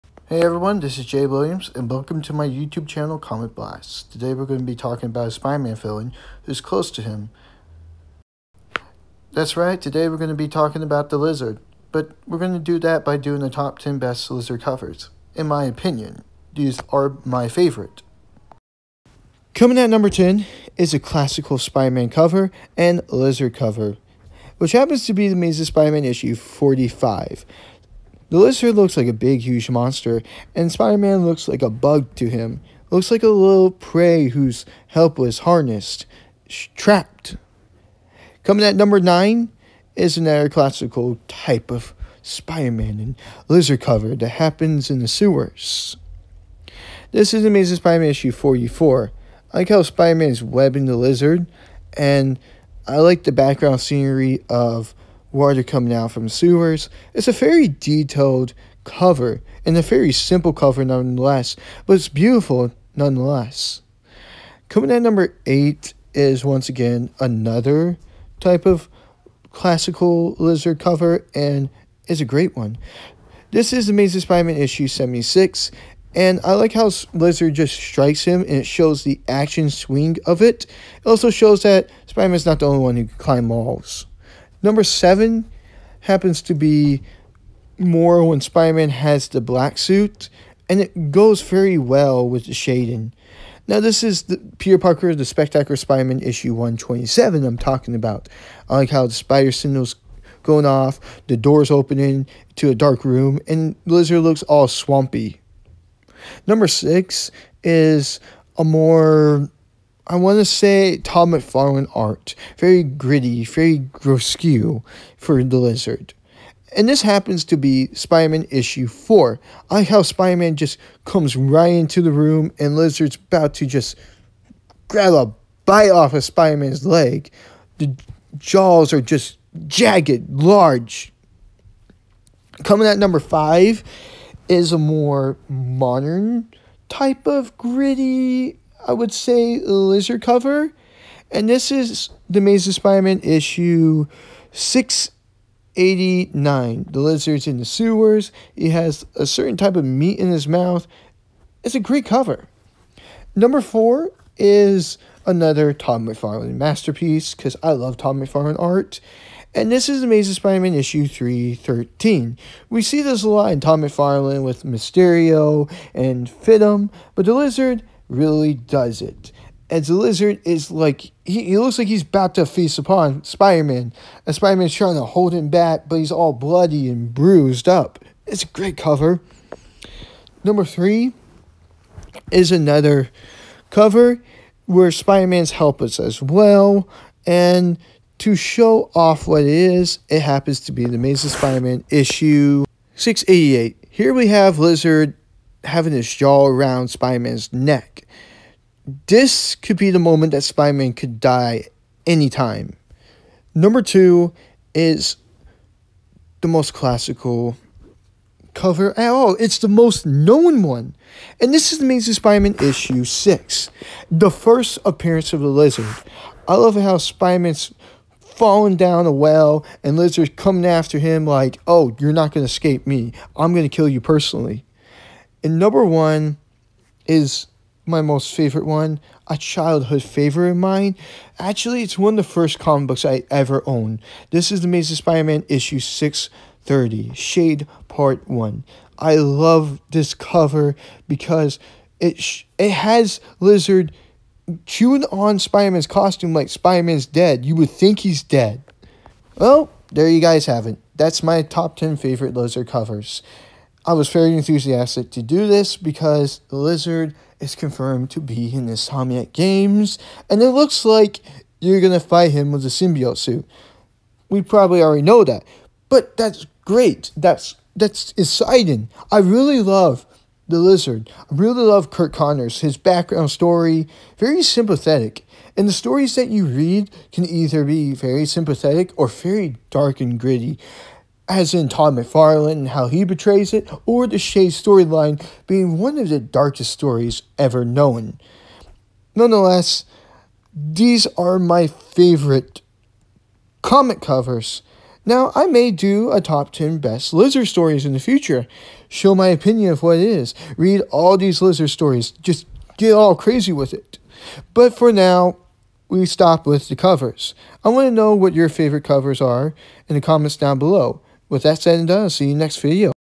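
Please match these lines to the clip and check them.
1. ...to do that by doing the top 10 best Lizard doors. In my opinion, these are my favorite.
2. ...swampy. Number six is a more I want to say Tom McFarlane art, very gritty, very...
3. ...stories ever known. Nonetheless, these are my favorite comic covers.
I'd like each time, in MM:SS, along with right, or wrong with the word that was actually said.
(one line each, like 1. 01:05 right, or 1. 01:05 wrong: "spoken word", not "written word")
1. 00:12 wrong: "covers", not "doors"
2. 01:44 right
3. 04:46 right.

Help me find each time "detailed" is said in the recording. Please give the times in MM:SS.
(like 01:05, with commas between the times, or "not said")
00:57.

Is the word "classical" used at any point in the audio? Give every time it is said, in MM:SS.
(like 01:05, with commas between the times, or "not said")
00:21, 00:40, 01:09, 03:26.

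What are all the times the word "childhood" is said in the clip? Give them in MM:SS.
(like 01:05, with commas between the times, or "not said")
03:49.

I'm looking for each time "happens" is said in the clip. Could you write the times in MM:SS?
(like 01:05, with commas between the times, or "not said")
00:24, 00:44, 01:26, 01:57, 03:10.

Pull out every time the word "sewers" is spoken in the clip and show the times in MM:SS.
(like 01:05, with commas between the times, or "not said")
00:45, 00:56, 02:27.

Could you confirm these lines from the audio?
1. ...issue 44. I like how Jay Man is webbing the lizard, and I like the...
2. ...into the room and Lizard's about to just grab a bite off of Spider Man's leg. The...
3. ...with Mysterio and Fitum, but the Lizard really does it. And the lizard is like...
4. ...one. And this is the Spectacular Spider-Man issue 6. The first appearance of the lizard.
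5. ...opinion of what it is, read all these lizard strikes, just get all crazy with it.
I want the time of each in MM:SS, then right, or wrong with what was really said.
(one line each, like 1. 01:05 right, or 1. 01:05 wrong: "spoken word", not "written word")
1. 00:48 wrong: "Spider", not "Jay"
2. 02:01 right
3. 02:44 right
4. 03:30 wrong: "Amazing", not "Spectacular"
5. 04:59 wrong: "stories", not "strikes".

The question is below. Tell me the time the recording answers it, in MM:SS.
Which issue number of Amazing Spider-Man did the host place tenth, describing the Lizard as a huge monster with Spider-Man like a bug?
00:26.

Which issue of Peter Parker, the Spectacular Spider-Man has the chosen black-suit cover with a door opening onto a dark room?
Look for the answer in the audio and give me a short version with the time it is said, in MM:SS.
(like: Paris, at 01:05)
127, at 01:36.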